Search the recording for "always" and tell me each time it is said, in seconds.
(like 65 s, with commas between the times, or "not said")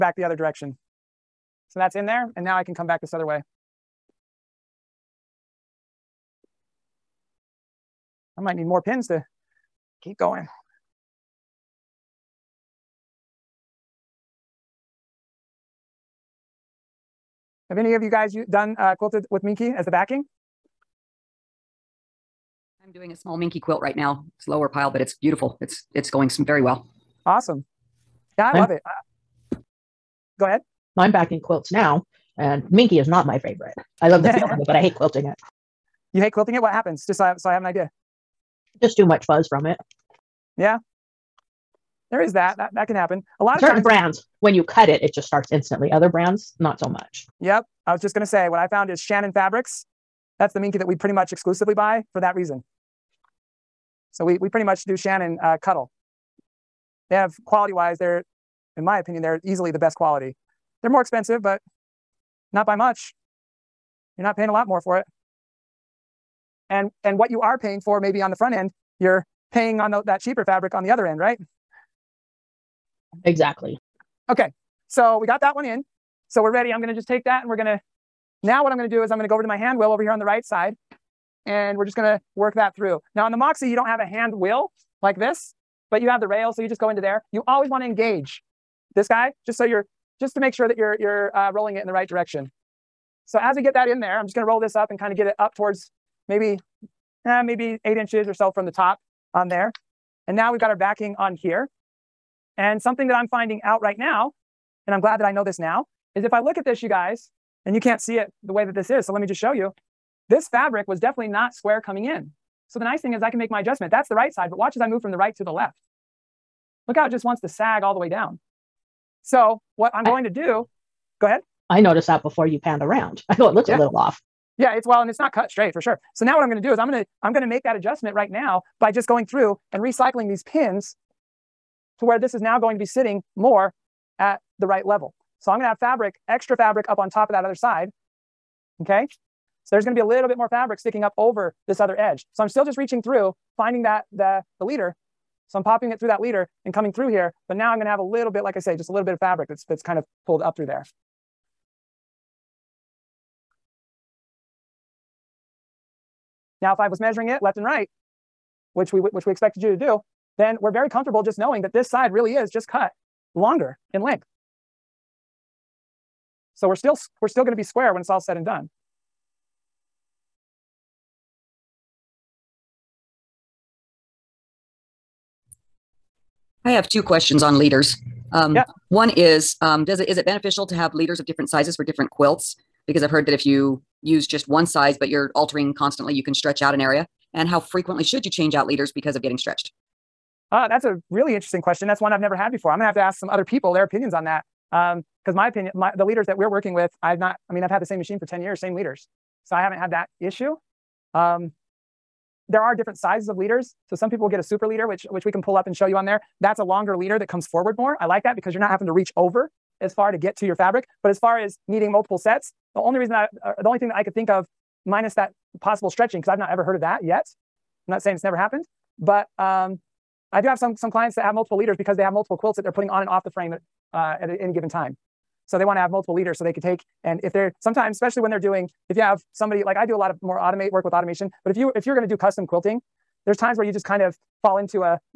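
87 s.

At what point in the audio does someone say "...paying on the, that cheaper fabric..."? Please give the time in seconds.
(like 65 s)
69 s.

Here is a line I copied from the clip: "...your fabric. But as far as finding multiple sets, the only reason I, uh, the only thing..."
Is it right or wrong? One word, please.
wrong.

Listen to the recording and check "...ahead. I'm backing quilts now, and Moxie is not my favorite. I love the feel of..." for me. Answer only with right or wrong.
wrong.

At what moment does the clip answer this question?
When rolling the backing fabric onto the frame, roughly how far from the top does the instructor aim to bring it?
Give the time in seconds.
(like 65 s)
97 s.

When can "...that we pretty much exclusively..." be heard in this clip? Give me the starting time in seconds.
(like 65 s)
50 s.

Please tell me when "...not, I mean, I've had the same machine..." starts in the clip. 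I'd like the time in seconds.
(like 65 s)
197 s.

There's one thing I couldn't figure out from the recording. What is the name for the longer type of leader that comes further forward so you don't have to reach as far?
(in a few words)
super leader.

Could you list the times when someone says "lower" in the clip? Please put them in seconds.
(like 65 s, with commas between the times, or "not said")
24 s.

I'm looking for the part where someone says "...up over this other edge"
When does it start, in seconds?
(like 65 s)
141 s.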